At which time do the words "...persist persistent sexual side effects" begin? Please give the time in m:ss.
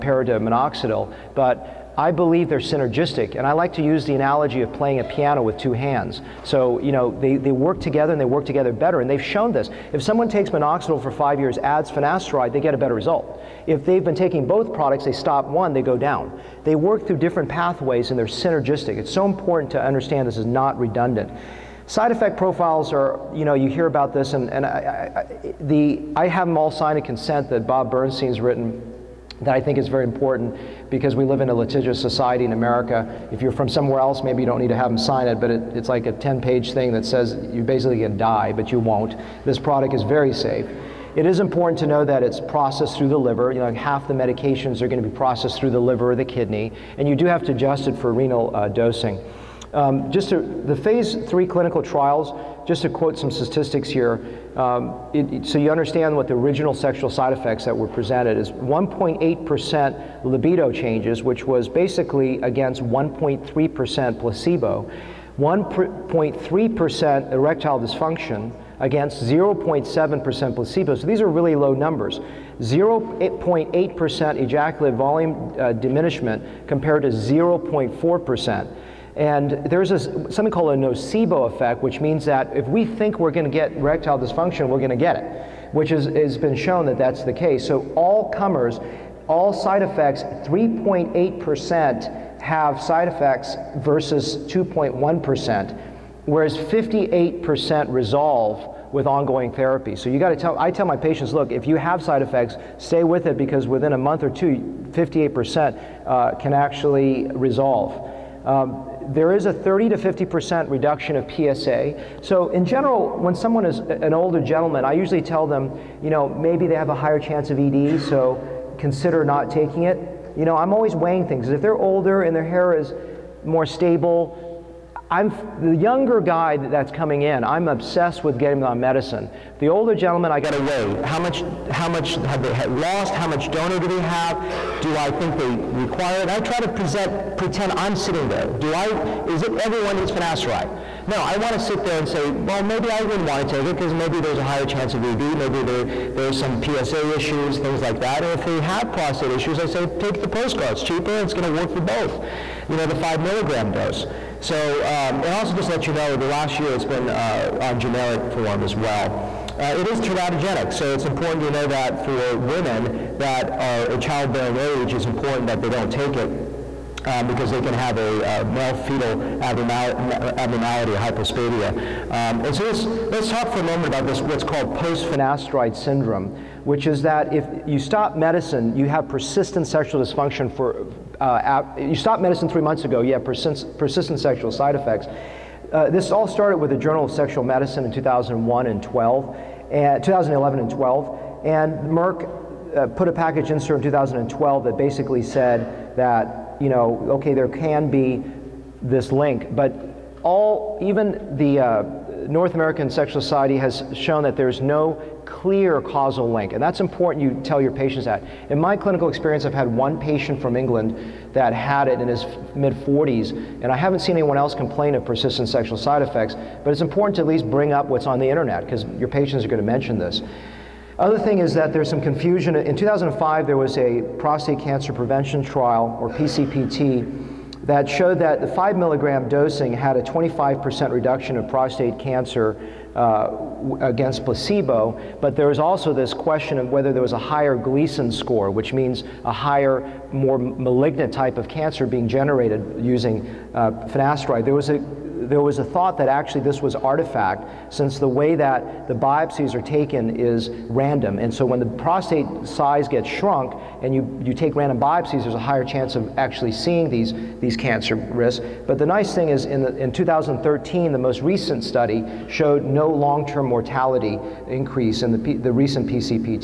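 3:03.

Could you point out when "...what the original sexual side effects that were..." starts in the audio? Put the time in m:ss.
0:56.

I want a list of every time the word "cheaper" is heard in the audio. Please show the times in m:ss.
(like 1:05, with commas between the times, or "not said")
2:30.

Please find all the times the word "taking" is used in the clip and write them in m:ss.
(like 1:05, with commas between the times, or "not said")
0:14, 1:59.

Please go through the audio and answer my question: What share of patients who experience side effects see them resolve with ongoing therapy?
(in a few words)
58%.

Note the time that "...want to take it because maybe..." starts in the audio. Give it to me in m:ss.
2:23.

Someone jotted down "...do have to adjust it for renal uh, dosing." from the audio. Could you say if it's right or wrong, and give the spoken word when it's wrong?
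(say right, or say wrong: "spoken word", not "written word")
right.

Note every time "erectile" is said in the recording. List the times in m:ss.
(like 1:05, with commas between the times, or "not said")
1:07, 1:23.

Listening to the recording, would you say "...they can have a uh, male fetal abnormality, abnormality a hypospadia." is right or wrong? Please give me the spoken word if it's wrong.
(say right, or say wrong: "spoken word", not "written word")
right.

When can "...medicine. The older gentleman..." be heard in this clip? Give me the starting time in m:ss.
2:08.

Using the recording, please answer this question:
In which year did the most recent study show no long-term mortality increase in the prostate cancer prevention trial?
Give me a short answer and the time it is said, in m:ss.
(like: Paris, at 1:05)
2013, at 4:19.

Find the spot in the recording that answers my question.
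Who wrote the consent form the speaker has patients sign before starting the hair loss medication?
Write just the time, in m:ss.
0:27.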